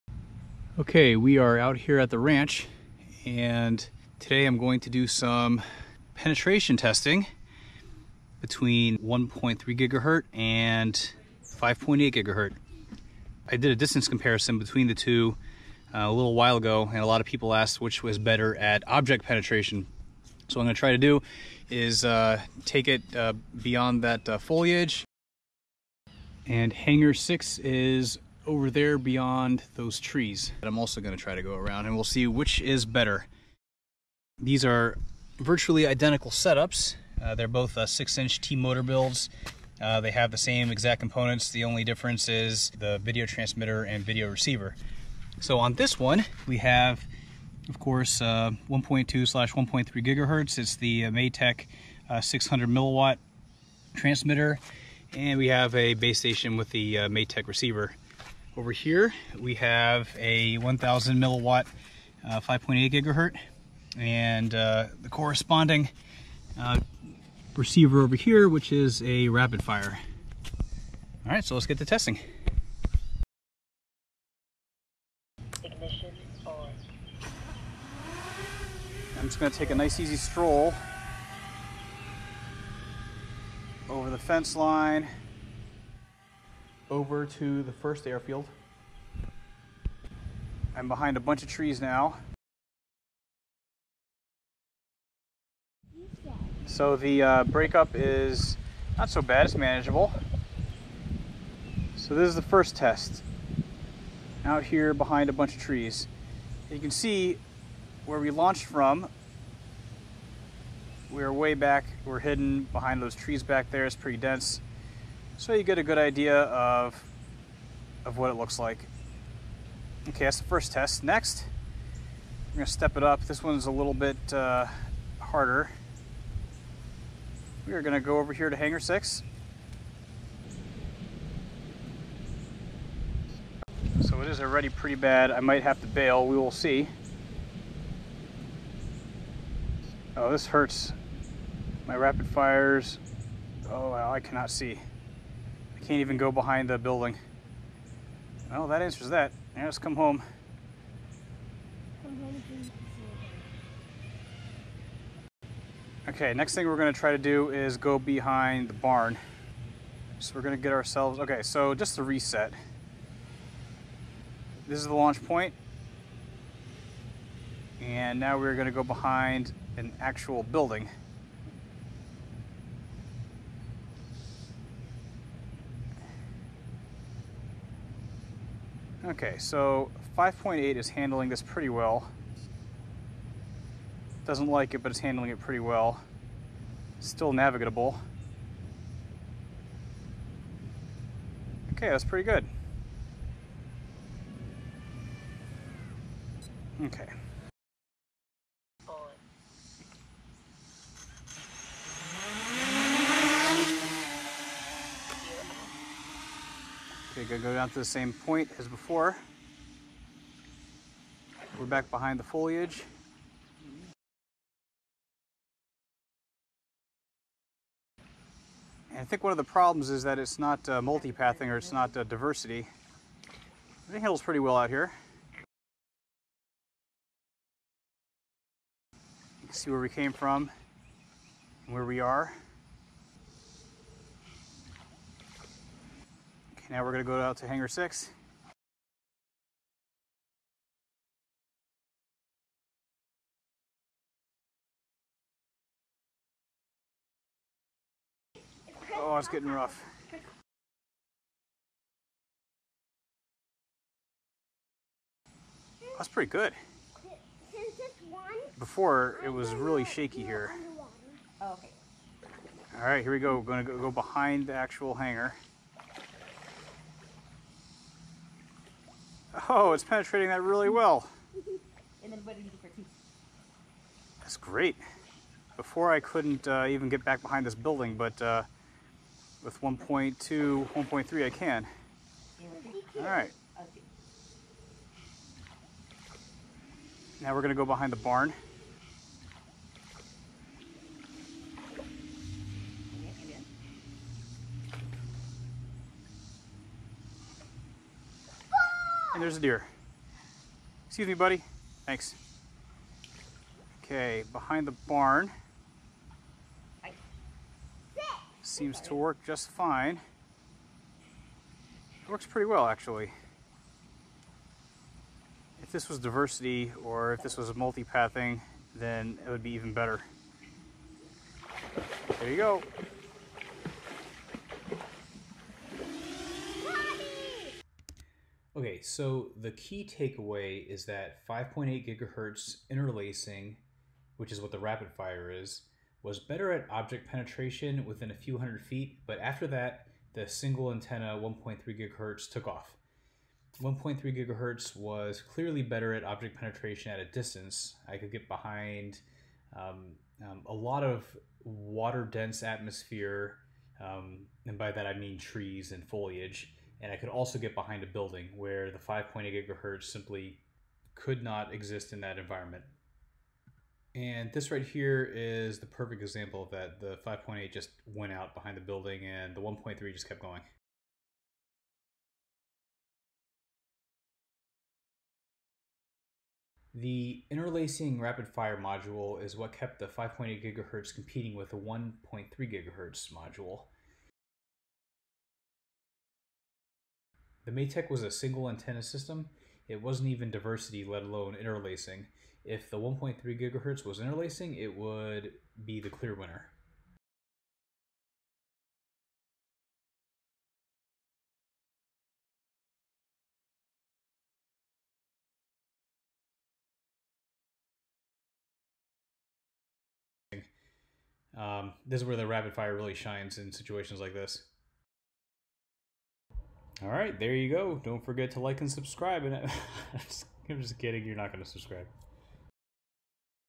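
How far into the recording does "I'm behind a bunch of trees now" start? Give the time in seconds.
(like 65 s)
90 s.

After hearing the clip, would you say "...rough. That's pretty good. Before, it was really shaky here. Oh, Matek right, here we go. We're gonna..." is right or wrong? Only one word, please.
wrong.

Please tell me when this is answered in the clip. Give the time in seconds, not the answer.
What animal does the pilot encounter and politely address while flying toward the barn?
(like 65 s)
299 s.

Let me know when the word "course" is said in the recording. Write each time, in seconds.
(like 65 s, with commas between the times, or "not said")
47 s.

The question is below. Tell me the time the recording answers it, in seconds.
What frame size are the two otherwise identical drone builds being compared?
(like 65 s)
37 s.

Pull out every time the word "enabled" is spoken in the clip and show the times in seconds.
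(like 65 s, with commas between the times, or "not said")
not said.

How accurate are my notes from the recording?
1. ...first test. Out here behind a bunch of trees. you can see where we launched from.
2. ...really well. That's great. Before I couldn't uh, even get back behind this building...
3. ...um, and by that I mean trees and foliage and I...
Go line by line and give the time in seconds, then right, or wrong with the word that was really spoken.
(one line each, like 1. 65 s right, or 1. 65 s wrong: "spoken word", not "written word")
1. 102 s right
2. 270 s right
3. 353 s right.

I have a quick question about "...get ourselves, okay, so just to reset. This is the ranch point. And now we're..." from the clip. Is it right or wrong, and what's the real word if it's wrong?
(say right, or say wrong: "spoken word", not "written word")
wrong: "launch", not "ranch".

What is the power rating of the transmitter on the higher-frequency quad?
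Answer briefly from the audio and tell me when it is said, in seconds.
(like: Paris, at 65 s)
1000 milliwatts, at 60 s.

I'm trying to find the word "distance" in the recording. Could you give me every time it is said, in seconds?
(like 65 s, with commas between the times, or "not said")
13 s, 347 s.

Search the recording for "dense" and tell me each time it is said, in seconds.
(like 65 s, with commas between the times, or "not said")
114 s, 352 s.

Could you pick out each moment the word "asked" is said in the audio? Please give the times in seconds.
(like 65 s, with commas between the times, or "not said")
17 s.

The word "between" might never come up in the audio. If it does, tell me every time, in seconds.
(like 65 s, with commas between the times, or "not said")
8 s, 14 s.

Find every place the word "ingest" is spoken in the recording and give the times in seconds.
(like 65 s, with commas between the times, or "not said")
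not said.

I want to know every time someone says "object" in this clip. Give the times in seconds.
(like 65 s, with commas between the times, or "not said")
18 s, 336 s, 346 s.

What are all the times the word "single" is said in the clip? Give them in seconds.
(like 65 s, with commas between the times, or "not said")
340 s, 388 s.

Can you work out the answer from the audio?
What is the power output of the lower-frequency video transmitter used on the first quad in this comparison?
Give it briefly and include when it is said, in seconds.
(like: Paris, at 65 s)
600 milliwatts, at 52 s.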